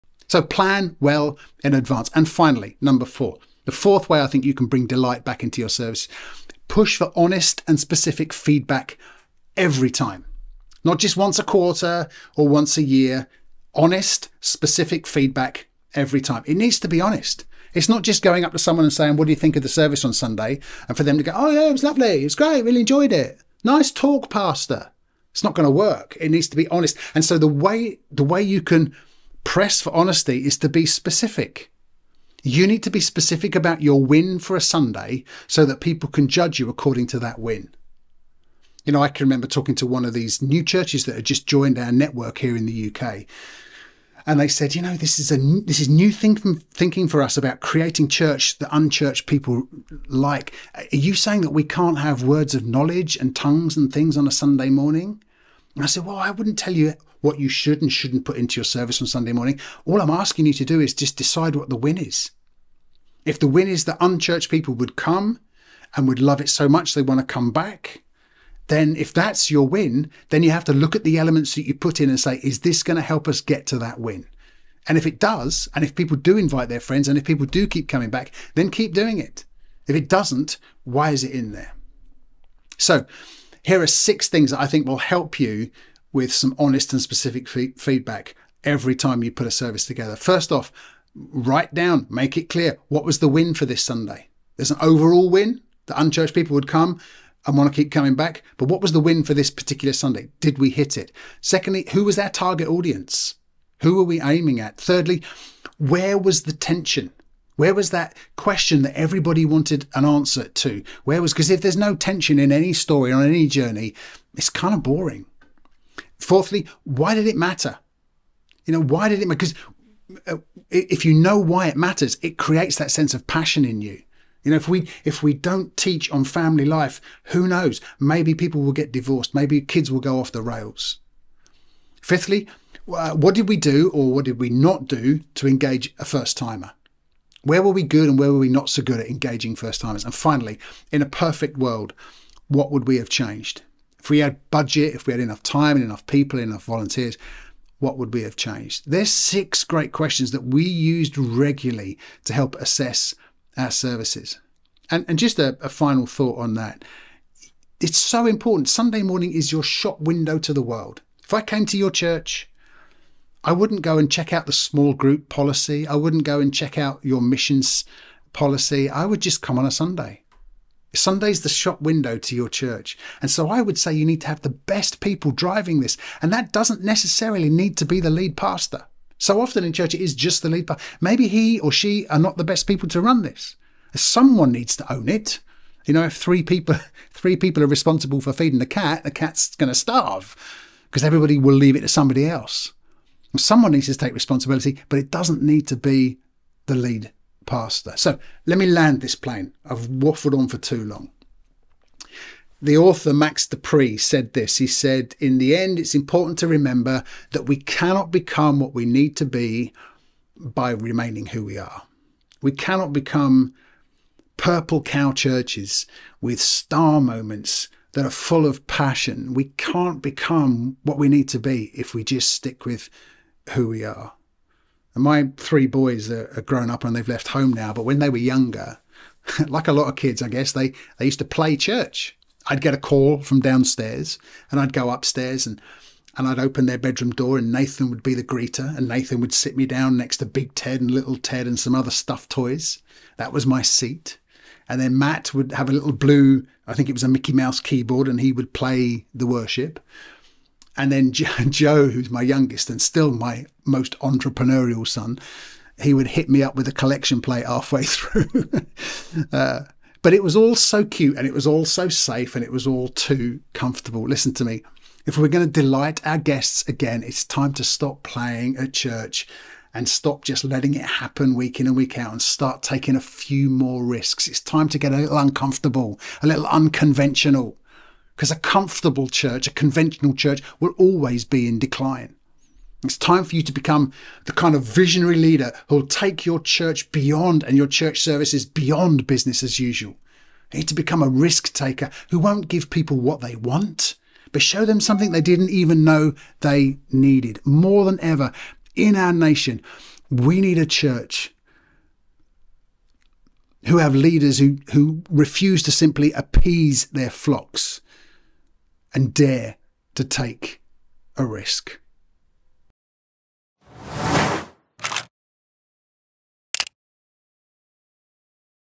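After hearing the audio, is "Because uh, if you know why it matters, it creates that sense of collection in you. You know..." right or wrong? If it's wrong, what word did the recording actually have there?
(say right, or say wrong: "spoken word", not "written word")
wrong: "passion", not "collection".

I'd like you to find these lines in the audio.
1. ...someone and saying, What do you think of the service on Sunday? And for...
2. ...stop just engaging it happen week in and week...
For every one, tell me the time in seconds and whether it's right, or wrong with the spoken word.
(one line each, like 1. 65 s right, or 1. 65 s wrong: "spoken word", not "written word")
1. 18 s right
2. 269 s wrong: "letting", not "engaging".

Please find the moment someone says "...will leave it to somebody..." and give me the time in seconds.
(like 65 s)
191 s.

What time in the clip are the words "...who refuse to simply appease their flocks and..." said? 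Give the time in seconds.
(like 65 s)
304 s.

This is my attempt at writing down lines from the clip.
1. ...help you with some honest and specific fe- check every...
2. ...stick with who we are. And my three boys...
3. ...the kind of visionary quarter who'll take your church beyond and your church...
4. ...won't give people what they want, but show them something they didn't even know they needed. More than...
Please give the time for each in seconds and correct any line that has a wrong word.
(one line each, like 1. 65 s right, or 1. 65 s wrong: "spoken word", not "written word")
1. 84 s wrong: "feedback", not "check"
2. 222 s right
3. 284 s wrong: "leader", not "quarter"
4. 292 s right.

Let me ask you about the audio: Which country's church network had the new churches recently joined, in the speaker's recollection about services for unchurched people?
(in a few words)
UK.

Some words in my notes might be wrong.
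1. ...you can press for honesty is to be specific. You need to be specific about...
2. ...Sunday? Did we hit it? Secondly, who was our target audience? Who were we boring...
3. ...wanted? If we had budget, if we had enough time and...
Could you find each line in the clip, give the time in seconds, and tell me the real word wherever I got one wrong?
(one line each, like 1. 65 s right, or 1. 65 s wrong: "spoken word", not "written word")
1. 28 s right
2. 99 s wrong: "aiming", not "boring"
3. 143 s wrong: "changed", not "wanted".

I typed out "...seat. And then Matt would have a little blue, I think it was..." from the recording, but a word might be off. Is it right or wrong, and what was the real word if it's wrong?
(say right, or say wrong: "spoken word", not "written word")
right.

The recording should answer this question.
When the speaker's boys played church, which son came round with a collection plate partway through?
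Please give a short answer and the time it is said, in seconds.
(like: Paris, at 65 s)
Joe, at 251 s.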